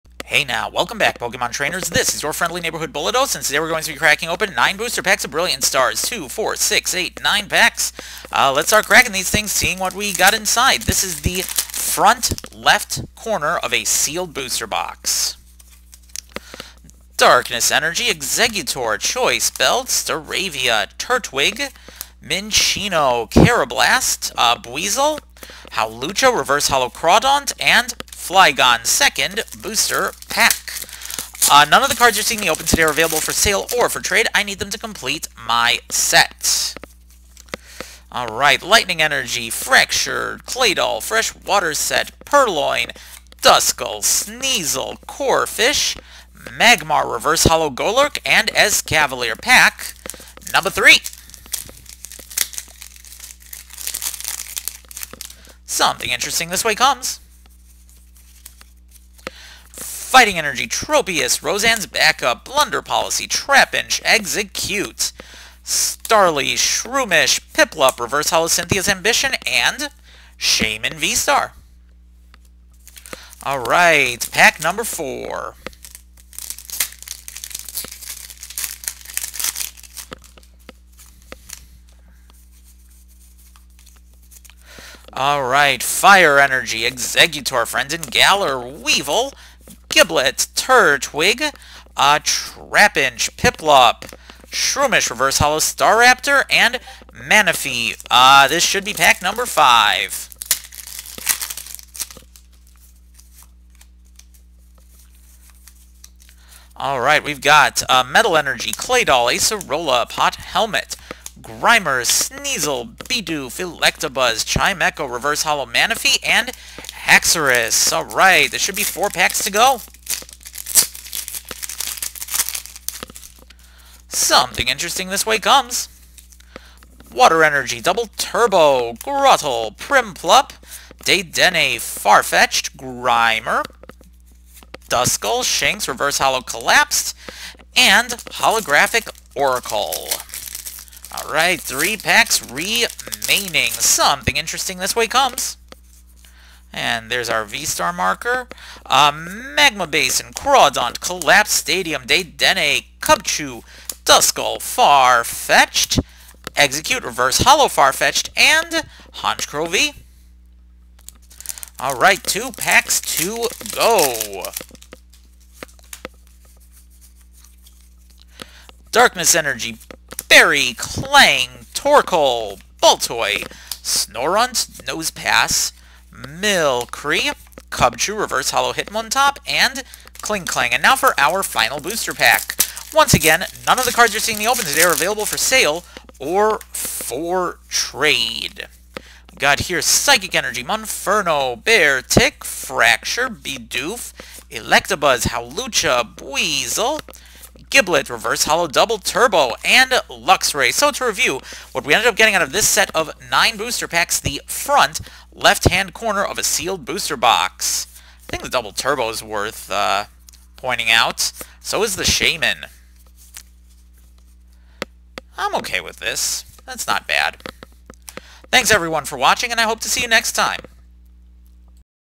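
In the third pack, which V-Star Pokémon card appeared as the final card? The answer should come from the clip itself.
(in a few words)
Shaymin V-Star.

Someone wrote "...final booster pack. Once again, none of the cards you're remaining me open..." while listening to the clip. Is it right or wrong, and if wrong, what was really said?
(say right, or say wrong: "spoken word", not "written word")
wrong: "seeing", not "remaining".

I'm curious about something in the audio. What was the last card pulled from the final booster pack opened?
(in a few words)
Luxray.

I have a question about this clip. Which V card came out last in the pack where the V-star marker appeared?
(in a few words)
Honchkrow V.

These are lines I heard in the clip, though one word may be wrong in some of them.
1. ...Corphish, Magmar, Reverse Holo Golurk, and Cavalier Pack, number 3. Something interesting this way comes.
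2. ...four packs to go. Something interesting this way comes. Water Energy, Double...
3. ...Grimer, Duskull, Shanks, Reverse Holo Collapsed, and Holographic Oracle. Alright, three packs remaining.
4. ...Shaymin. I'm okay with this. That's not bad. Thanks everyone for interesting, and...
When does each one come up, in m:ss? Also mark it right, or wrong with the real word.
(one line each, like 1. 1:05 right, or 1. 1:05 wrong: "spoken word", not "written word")
1. 0:45 right
2. 1:58 right
3. 2:12 right
4. 3:32 wrong: "watching", not "interesting".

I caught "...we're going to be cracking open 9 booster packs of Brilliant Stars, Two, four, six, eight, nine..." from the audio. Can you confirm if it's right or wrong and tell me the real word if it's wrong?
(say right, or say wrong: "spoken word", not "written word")
right.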